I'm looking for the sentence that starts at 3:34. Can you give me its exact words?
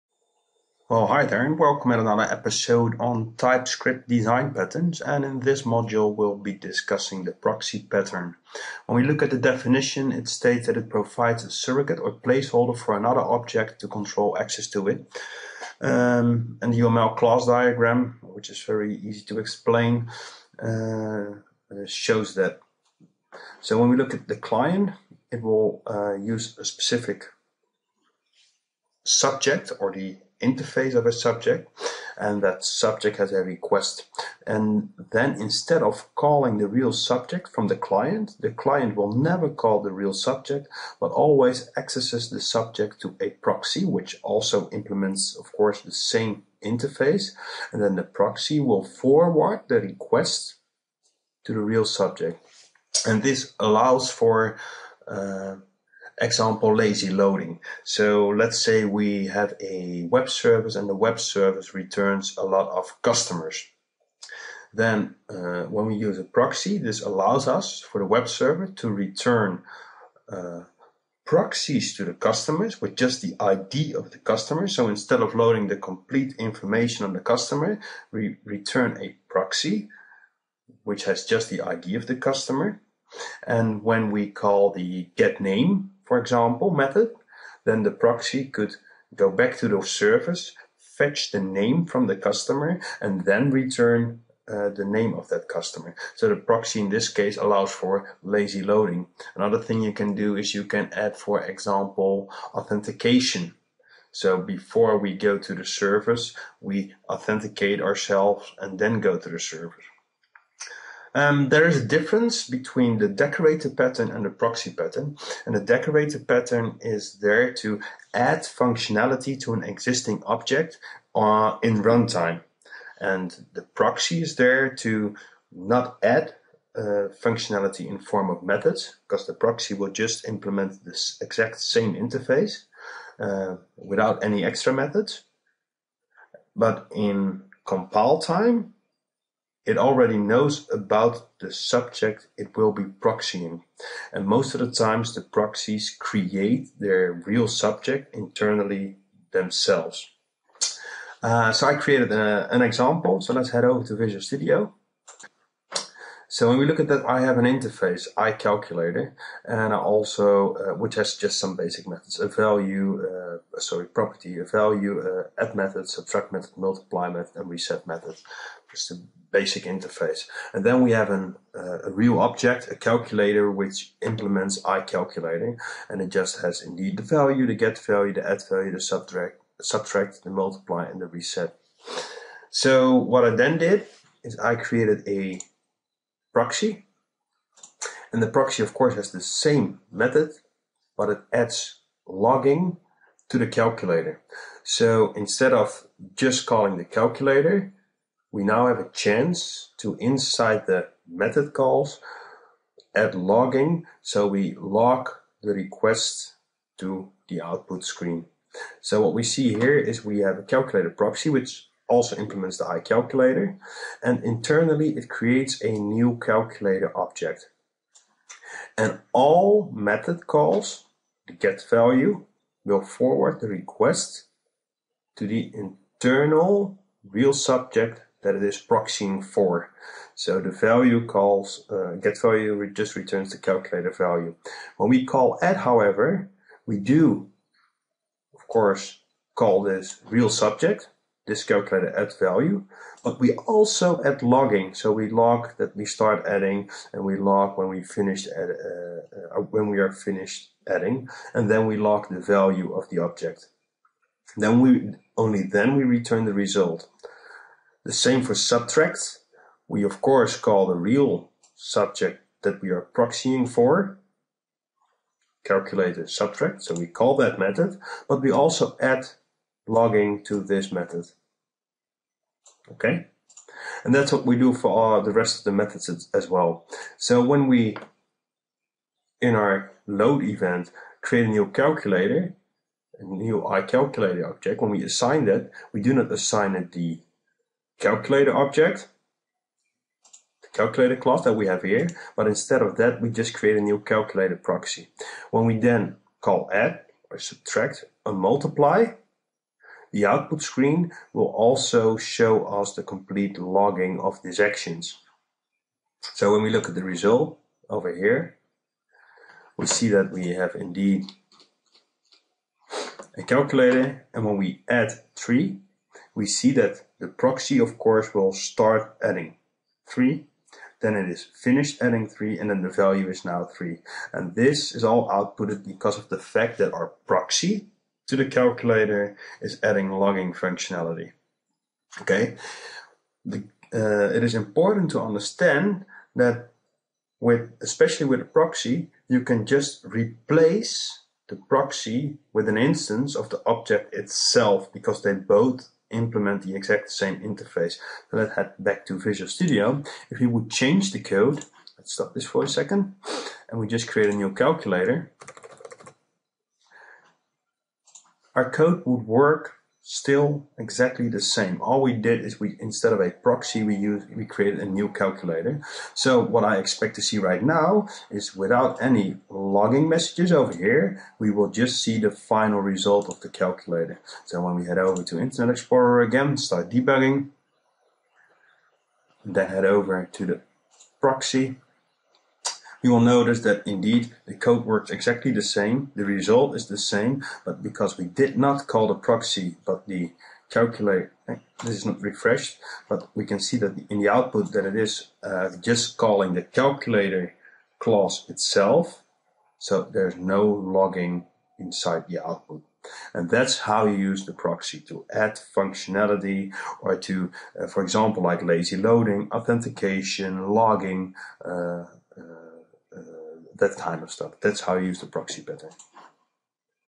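And internally, it creates a new calculator object.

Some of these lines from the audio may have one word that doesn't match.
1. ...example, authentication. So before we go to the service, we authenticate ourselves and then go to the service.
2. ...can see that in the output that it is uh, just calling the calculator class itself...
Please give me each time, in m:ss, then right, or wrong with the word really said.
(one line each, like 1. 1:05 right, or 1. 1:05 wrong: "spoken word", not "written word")
1. 1:41 right
2. 6:33 right.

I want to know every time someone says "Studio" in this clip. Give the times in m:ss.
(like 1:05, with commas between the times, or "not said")
2:34, 5:49.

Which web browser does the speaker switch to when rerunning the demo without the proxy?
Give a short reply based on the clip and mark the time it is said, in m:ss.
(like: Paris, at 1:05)
Internet Explorer, at 6:15.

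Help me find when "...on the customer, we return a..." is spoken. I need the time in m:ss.
1:17.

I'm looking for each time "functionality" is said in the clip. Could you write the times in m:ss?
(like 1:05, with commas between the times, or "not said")
1:58, 2:07, 5:30, 6:45.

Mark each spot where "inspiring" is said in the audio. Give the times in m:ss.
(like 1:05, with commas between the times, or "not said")
not said.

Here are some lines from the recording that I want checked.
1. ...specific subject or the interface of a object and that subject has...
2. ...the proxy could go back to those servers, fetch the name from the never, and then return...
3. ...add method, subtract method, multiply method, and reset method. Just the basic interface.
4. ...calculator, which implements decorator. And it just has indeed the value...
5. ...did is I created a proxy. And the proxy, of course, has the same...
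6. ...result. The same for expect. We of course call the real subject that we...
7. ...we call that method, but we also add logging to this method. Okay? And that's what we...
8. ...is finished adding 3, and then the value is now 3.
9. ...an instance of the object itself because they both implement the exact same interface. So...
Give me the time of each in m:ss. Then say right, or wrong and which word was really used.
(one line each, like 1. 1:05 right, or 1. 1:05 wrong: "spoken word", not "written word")
1. 0:26 wrong: "subject", not "object"
2. 1:27 wrong: "customer", not "never"
3. 2:45 right
4. 2:52 wrong: "iCalculator", not "decorator"
5. 3:03 right
6. 4:16 wrong: "subtract", not "expect"
7. 4:26 right
8. 5:21 right
9. 5:42 right.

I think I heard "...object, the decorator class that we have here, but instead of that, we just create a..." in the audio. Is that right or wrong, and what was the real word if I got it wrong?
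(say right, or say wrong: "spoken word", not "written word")
wrong: "calculator", not "decorator".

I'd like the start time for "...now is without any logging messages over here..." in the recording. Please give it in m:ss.
6:07.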